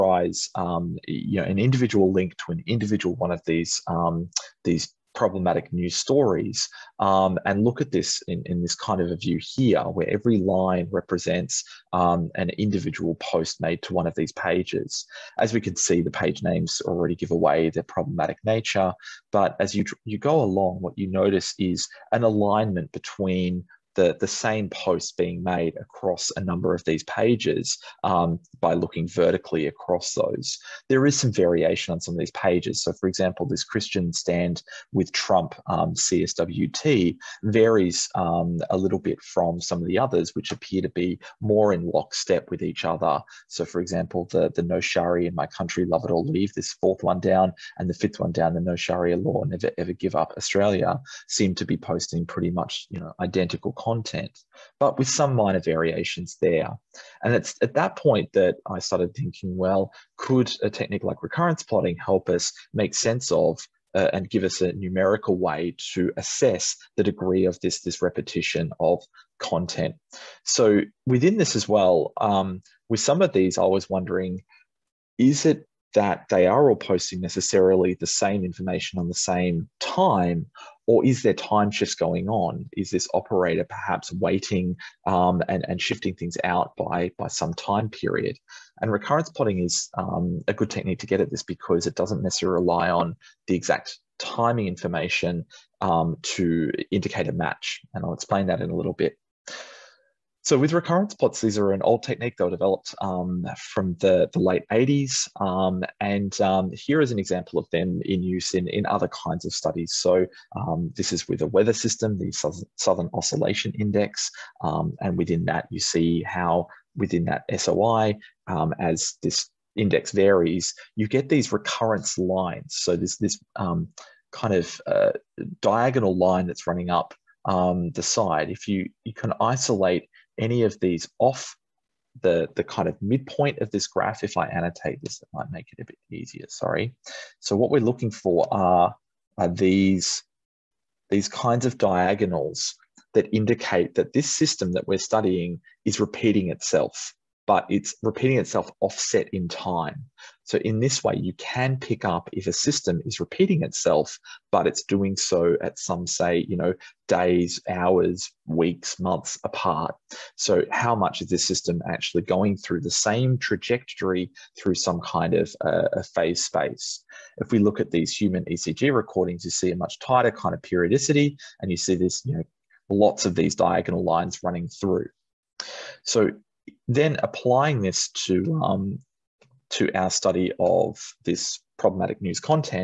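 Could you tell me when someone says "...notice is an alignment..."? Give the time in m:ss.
0:21.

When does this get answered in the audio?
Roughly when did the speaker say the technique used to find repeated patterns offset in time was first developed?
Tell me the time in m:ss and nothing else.
1:44.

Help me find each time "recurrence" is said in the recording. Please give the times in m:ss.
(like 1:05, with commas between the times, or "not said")
1:01, 1:28, 1:40, 2:01.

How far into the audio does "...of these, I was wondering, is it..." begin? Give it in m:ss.
1:13.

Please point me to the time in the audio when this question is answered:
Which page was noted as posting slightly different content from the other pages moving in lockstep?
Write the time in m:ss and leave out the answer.
0:33.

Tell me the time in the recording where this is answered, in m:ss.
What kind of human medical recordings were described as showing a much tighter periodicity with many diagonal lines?
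2:48.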